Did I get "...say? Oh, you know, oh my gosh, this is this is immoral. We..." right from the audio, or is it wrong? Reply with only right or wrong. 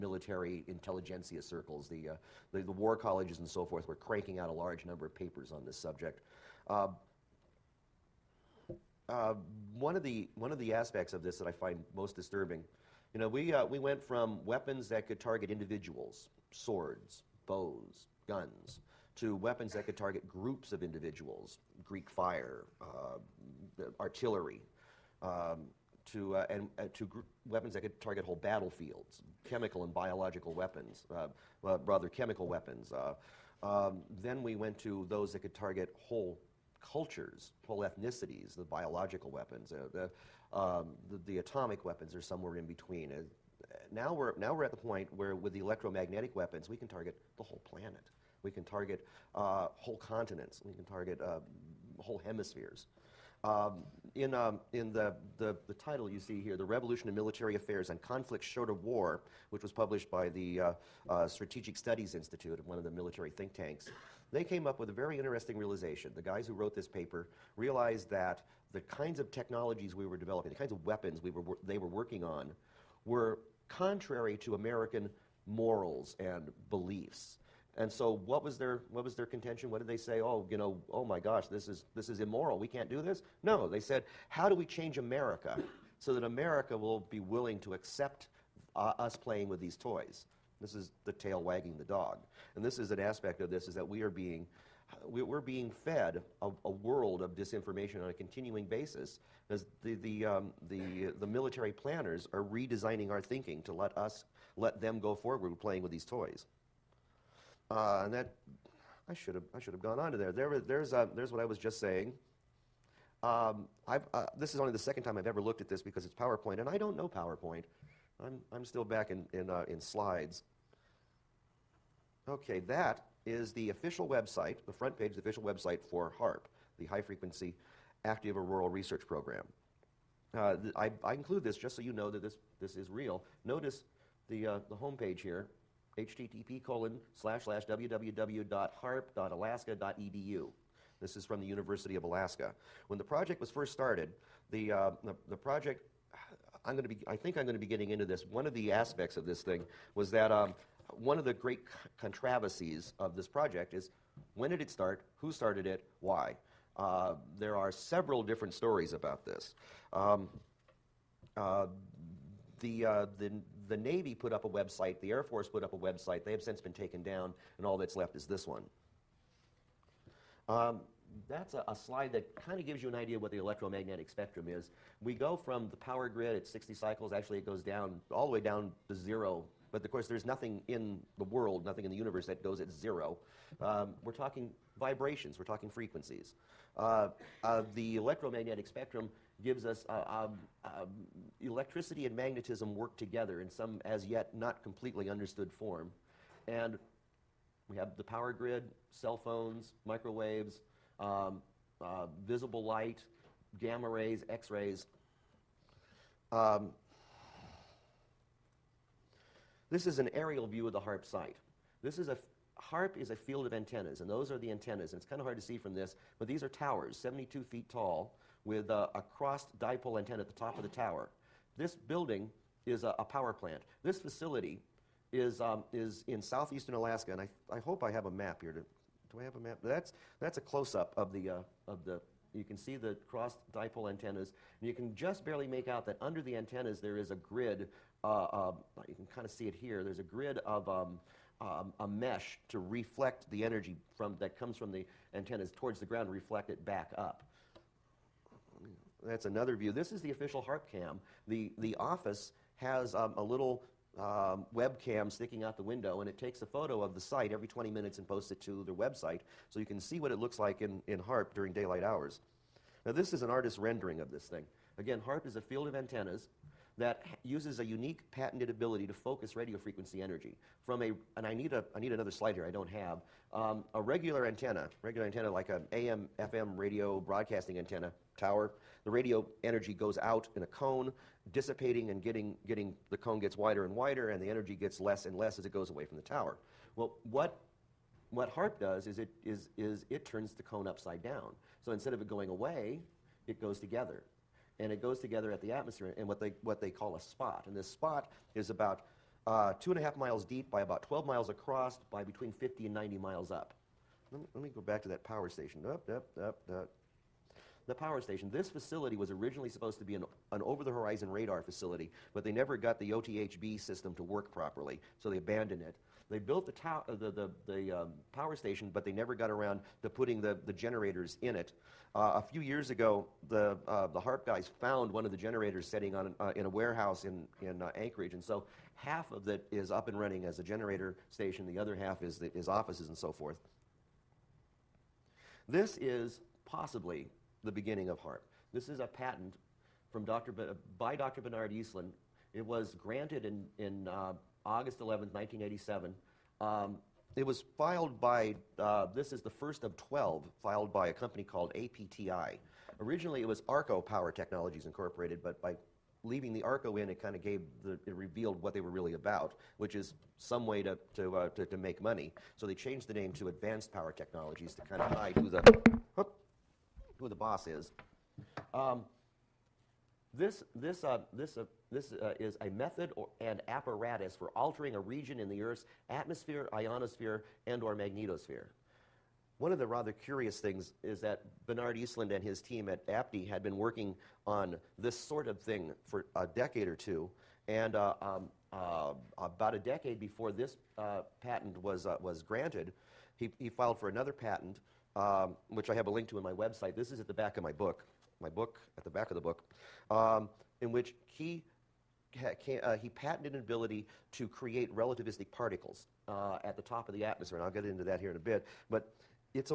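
right.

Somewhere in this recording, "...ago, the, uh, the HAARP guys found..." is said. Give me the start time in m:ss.
5:22.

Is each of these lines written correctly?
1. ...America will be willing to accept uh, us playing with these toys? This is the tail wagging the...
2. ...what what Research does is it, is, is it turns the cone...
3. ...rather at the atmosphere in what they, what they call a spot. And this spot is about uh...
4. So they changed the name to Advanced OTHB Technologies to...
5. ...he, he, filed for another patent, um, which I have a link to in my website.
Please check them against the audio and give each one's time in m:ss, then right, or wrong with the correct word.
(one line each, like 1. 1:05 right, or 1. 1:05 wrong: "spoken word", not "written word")
1. 1:26 right
2. 4:47 wrong: "HAARP", not "Research"
3. 4:54 wrong: "together", not "rather"
4. 6:02 wrong: "Power", not "OTHB"
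5. 6:33 right.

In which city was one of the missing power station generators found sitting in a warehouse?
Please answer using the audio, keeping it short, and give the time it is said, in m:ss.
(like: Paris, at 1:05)
Anchorage, at 5:27.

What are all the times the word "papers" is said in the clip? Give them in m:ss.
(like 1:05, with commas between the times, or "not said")
0:05, 1:06.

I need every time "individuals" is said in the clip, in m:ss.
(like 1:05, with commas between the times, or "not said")
0:15, 0:20.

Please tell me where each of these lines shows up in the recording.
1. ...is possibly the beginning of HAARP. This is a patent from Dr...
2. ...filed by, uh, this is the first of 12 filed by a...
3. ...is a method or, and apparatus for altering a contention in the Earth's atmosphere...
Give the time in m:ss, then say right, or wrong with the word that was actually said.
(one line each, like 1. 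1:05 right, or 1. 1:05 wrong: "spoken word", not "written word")
1. 5:35 right
2. 5:47 right
3. 6:12 wrong: "region", not "contention".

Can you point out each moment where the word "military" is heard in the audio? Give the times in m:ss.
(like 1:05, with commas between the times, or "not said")
0:57, 1:02, 1:41.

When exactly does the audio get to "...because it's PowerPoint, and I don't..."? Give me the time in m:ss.
1:55.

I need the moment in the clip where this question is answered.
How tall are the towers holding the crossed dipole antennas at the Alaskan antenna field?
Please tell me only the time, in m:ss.
3:36.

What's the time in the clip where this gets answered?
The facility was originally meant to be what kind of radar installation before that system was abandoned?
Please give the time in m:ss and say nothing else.
5:10.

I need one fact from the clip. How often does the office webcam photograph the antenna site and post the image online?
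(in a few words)
every 20 minutes.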